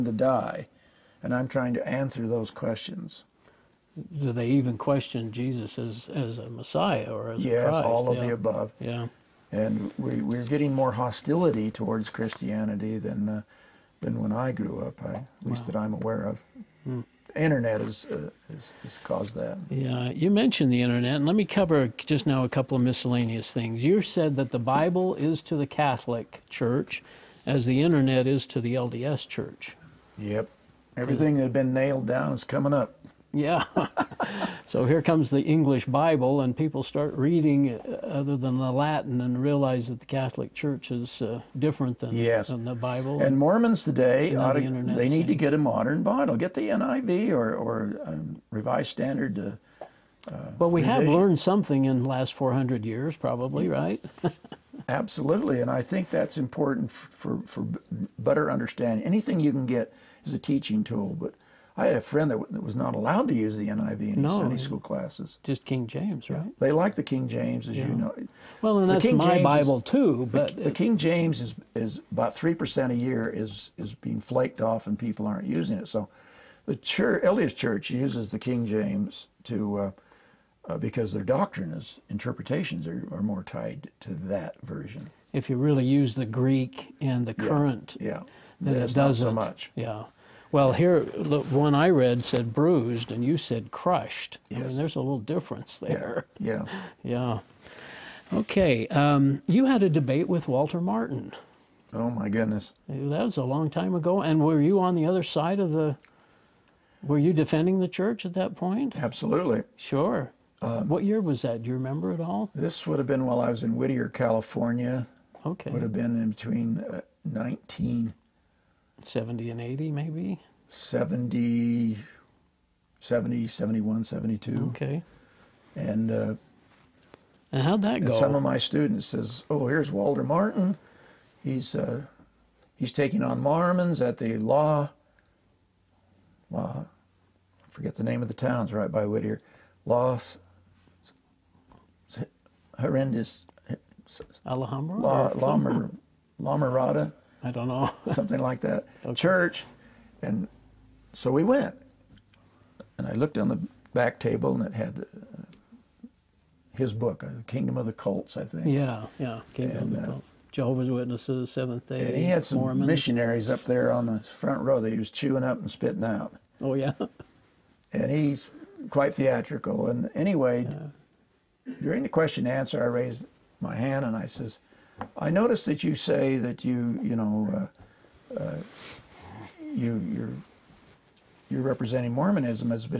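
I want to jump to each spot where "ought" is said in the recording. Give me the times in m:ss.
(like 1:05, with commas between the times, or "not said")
0:44.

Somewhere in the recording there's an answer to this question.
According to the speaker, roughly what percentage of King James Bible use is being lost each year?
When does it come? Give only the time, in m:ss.
1:12.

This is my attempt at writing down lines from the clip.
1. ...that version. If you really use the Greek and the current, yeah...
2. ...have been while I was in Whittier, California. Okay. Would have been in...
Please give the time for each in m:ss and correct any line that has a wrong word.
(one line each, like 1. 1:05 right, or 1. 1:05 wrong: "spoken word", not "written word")
1. 1:24 right
2. 1:52 right.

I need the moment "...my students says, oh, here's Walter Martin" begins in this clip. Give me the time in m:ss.
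2:08.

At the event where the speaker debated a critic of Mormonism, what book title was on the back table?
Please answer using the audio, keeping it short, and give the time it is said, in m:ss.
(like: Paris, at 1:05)
Kingdom of the Cults, at 2:37.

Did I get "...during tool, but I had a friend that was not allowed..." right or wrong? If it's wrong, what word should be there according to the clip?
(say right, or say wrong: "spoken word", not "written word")
wrong: "teaching", not "during".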